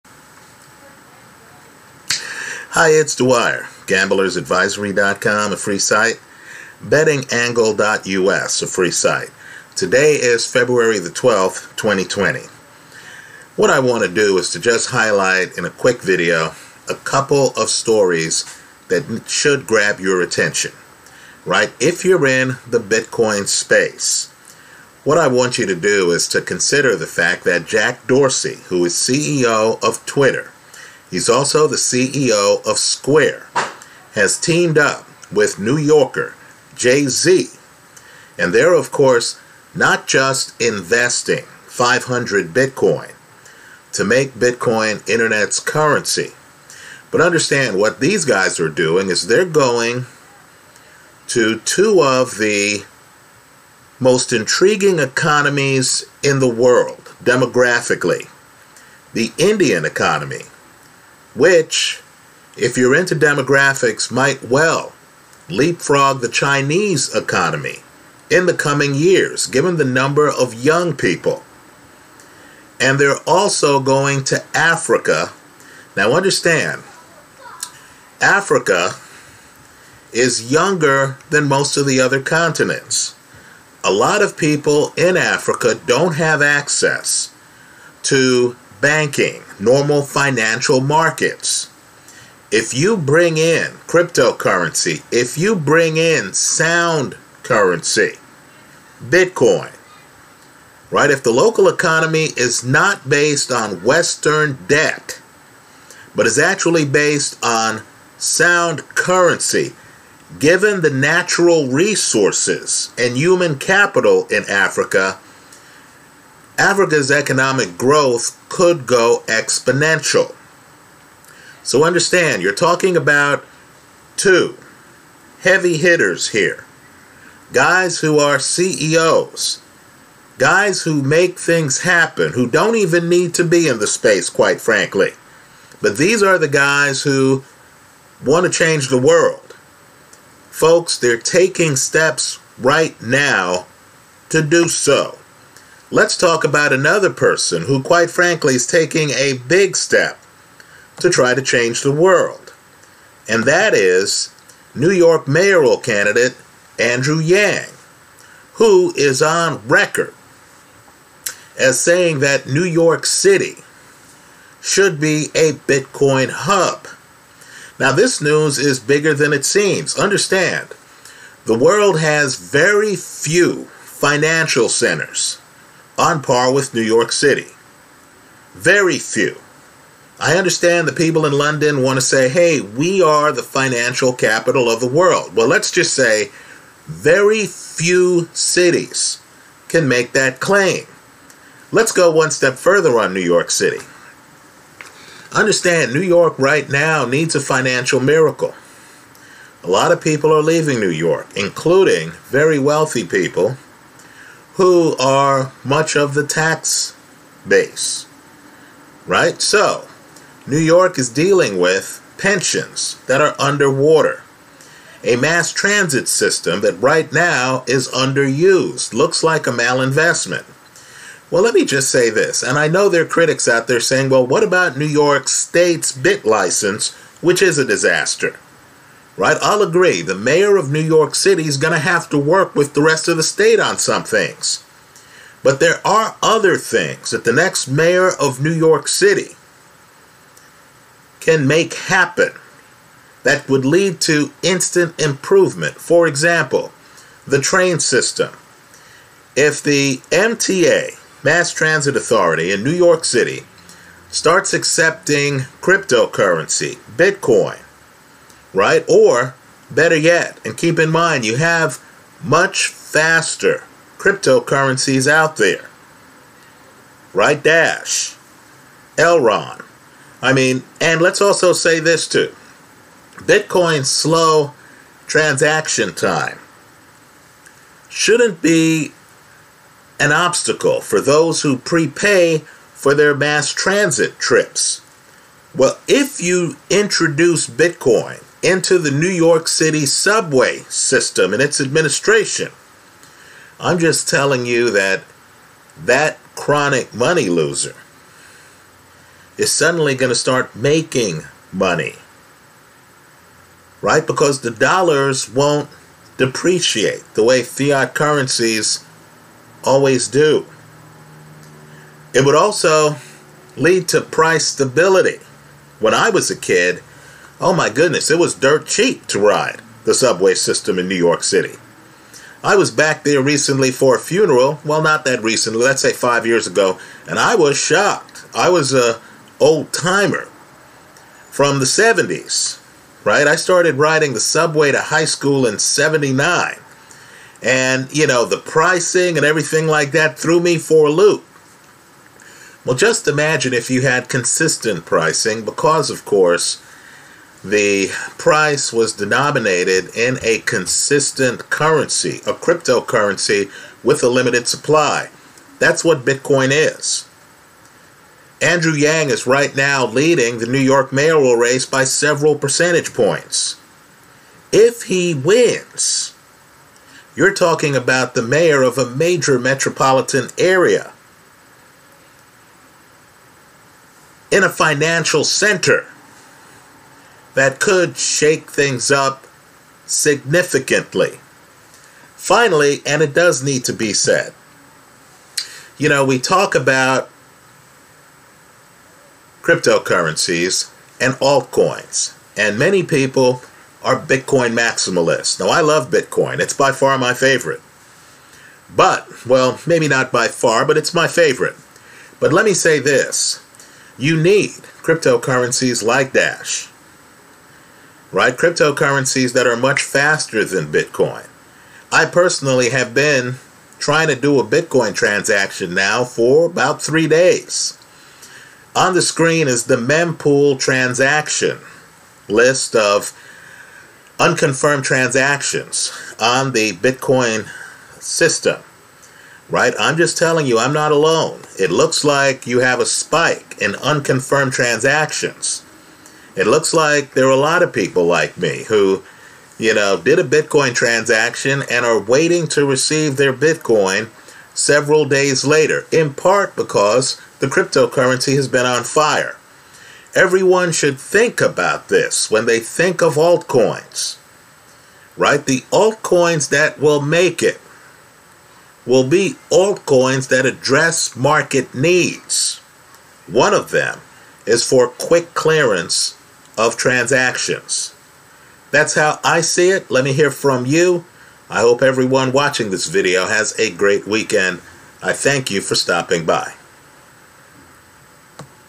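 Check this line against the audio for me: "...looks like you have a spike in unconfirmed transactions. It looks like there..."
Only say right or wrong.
right.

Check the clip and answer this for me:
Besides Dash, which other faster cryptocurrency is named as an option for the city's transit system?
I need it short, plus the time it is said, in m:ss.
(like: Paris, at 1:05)
Elrond, at 4:28.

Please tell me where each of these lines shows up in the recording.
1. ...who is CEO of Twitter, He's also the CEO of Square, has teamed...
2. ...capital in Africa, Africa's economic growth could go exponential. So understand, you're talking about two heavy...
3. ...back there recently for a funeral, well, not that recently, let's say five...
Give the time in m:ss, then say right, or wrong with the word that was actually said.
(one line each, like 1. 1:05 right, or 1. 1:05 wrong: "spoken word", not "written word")
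1. 0:28 right
2. 1:53 right
3. 5:22 right.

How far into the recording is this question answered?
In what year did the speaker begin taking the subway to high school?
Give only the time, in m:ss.
5:35.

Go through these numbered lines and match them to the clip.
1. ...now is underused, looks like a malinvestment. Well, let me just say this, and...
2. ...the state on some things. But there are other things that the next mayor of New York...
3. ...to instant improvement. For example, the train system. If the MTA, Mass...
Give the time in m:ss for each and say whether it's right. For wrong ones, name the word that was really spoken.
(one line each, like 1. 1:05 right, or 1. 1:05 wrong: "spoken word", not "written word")
1. 3:37 right
2. 3:53 right
3. 4:04 right.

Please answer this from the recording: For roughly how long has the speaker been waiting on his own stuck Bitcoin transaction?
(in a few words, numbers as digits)
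3 days.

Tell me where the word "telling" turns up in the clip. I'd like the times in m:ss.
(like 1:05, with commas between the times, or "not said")
4:54, 7:10.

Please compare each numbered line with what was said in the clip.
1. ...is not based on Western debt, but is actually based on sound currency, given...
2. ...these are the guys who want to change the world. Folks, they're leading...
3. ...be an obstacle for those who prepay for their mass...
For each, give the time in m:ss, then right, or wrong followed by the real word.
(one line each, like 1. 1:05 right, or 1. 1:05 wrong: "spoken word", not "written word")
1. 1:42 right
2. 2:15 wrong: "taking", not "leading"
3. 4:38 right.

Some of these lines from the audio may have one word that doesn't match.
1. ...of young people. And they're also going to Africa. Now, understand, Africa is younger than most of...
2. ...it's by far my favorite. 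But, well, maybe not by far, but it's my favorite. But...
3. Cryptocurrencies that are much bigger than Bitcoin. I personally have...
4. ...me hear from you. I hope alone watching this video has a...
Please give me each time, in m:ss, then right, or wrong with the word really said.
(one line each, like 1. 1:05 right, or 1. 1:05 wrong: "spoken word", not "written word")
1. 1:10 right
2. 6:36 right
3. 6:48 wrong: "faster", not "bigger"
4. 7:50 wrong: "everyone", not "alone".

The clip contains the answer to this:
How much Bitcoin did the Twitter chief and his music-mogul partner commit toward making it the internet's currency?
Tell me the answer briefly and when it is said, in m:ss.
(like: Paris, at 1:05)
500 Bitcoin, at 0:41.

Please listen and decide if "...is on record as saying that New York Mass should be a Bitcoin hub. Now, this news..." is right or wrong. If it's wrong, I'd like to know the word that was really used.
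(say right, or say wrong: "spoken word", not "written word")
wrong: "City", not "Mass".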